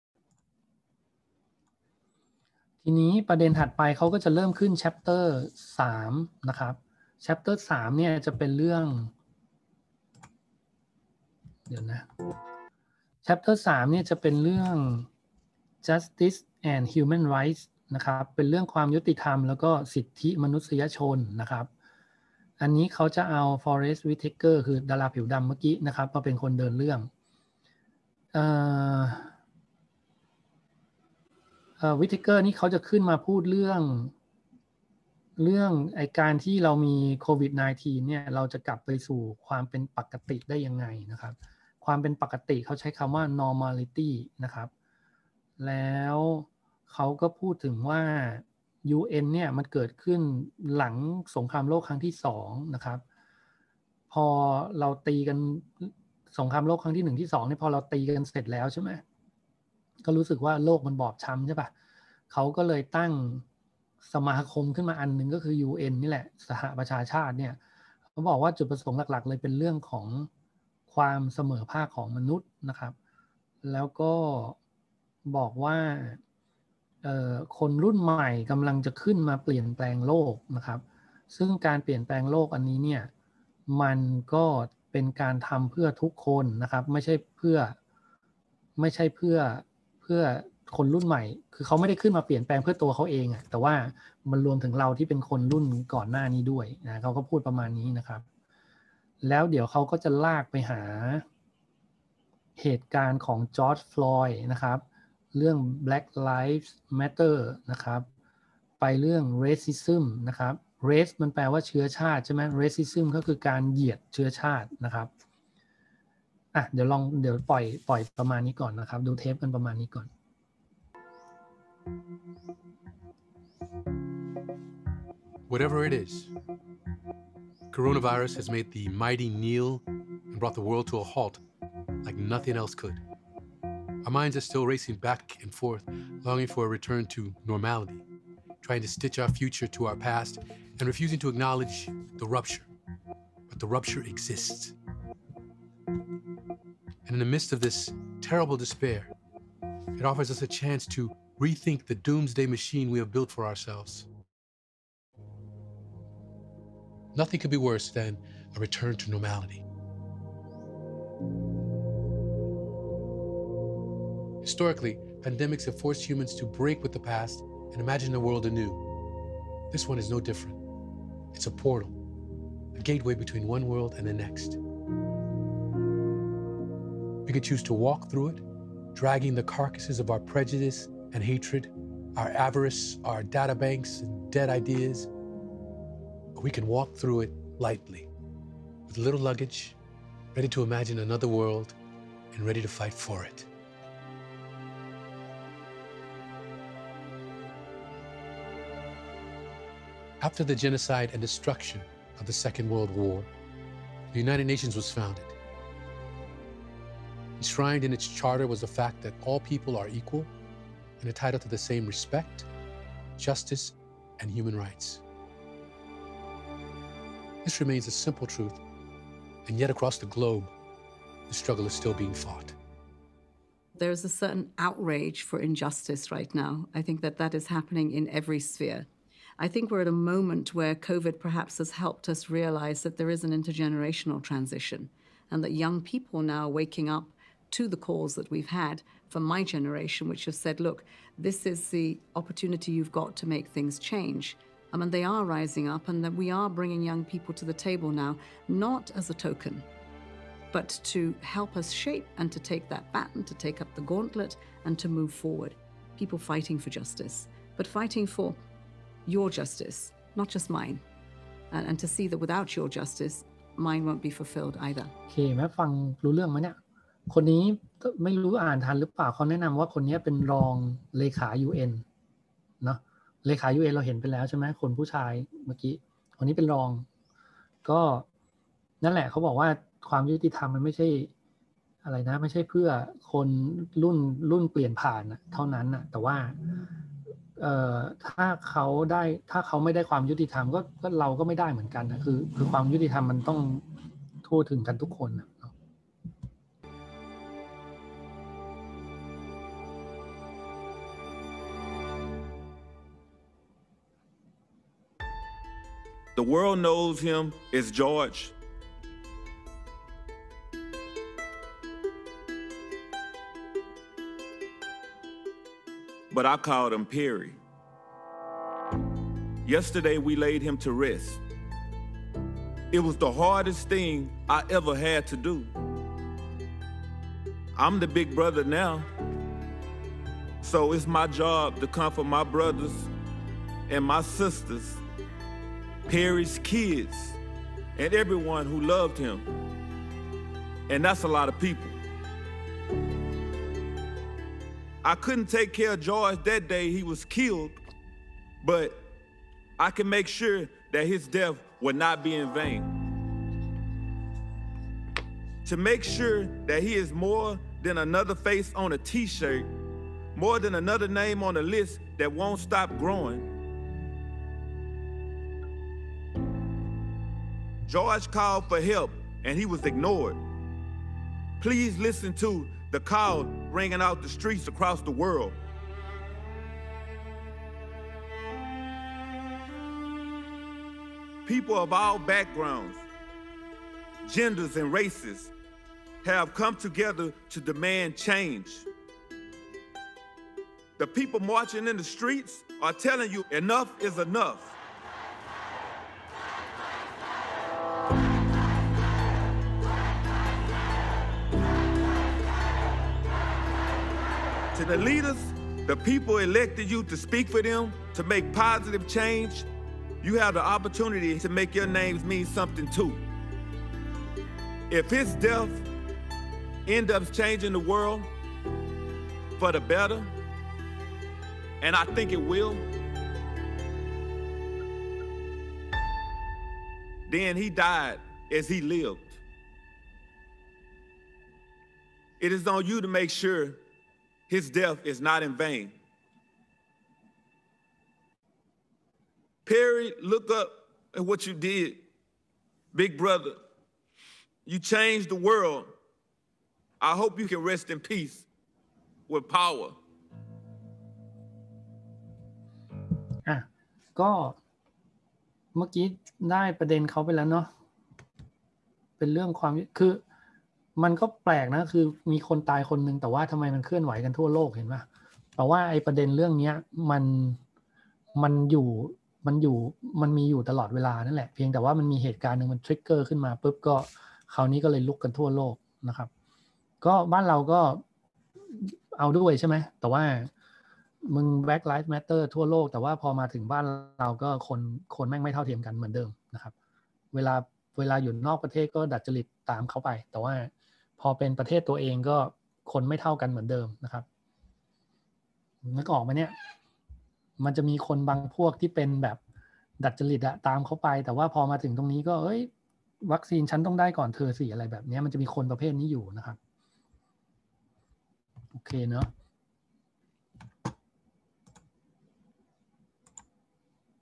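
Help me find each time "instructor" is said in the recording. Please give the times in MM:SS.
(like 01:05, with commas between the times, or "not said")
not said.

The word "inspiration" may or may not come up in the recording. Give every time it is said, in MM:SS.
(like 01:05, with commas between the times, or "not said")
not said.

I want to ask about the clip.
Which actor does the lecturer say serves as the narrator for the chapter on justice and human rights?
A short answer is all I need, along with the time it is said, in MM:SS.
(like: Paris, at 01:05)
Forest Whitaker, at 00:23.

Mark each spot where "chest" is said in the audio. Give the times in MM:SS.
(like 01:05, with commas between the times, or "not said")
not said.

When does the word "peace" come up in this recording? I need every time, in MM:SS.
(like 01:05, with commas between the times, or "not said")
07:27.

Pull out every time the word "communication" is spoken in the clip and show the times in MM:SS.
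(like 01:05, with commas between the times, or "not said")
not said.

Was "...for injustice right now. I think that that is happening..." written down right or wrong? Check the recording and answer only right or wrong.
right.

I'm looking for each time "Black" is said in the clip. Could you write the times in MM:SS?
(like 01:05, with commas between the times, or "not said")
01:45, 08:01.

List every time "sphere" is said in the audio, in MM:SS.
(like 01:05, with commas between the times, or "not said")
03:48.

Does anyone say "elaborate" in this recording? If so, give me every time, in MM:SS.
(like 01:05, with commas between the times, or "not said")
not said.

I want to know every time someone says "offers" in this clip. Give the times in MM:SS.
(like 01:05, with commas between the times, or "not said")
02:30.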